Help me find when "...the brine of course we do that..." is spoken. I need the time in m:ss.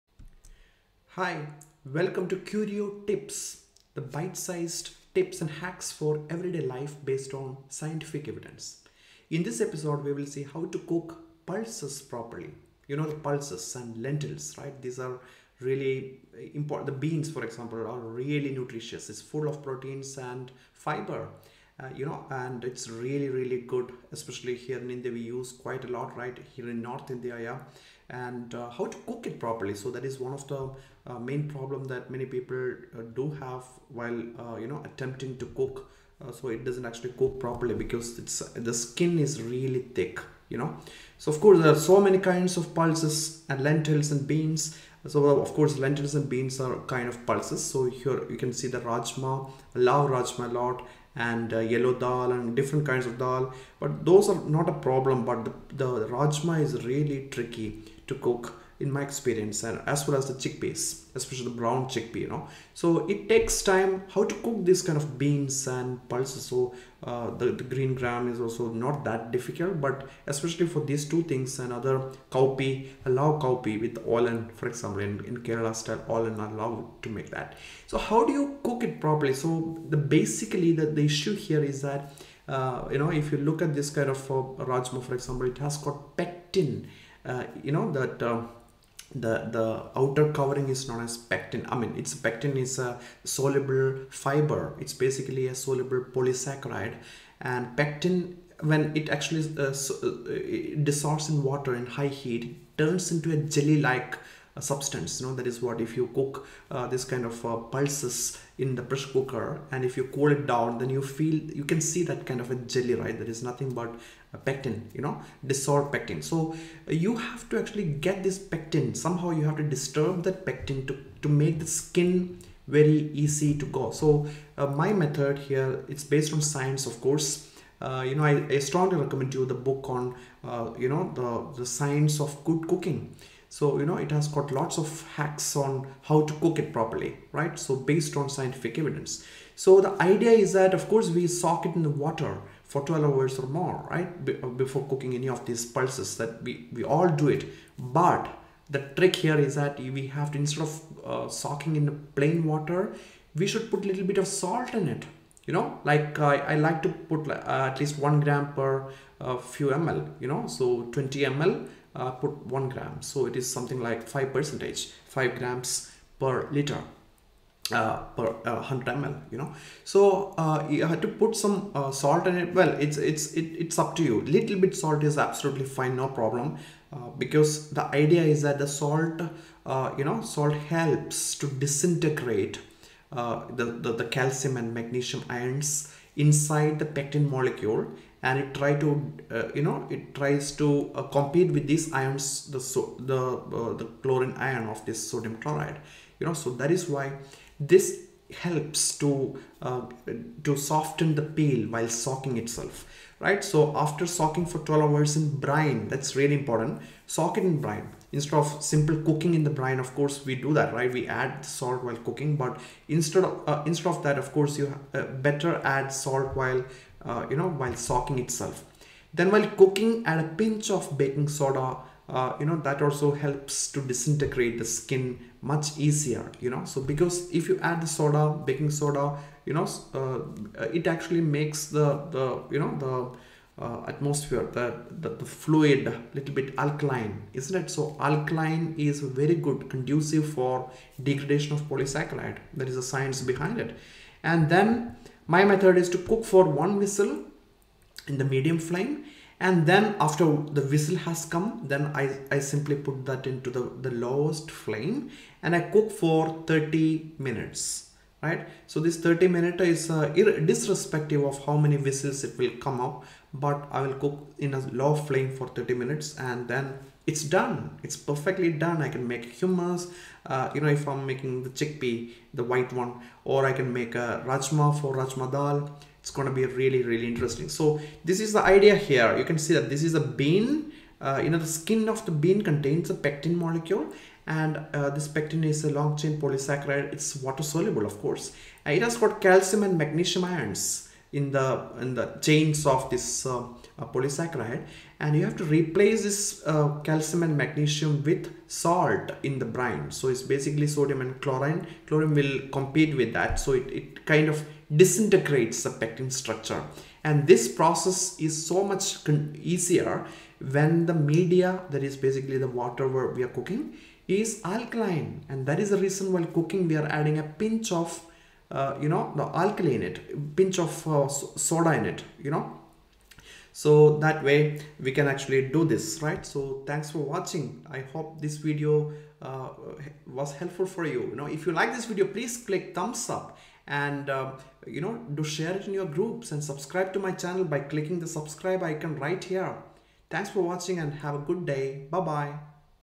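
3:29.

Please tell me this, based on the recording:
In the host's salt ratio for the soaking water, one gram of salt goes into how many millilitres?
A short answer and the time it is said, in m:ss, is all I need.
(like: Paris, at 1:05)
20 ml, at 2:40.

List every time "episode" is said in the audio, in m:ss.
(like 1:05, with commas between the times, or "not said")
0:09.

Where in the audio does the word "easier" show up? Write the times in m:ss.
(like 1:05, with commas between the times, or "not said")
3:45, 5:09.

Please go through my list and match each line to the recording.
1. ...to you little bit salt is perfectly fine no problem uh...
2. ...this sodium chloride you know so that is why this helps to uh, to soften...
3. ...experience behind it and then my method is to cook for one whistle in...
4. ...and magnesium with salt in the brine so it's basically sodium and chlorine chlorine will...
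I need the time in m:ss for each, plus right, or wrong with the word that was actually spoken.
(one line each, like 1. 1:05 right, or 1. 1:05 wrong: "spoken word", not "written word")
1. 2:53 wrong: "absolutely", not "perfectly"
2. 3:14 right
3. 4:02 wrong: "science", not "experience"
4. 4:57 right.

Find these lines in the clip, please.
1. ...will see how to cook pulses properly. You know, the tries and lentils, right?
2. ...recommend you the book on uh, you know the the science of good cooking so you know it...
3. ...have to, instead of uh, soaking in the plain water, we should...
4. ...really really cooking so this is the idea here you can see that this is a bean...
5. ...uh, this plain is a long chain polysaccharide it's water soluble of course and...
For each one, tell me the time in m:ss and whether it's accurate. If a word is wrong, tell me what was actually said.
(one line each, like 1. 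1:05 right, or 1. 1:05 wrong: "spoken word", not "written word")
1. 0:10 wrong: "pulses", not "tries"
2. 2:08 right
3. 2:30 right
4. 4:36 wrong: "interesting", not "cooking"
5. 4:44 wrong: "pectin", not "plain".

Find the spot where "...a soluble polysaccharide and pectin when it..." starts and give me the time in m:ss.
1:35.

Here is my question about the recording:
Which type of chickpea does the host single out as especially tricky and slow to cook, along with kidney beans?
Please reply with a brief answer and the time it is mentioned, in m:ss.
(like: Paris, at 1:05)
brown chickpea, at 1:01.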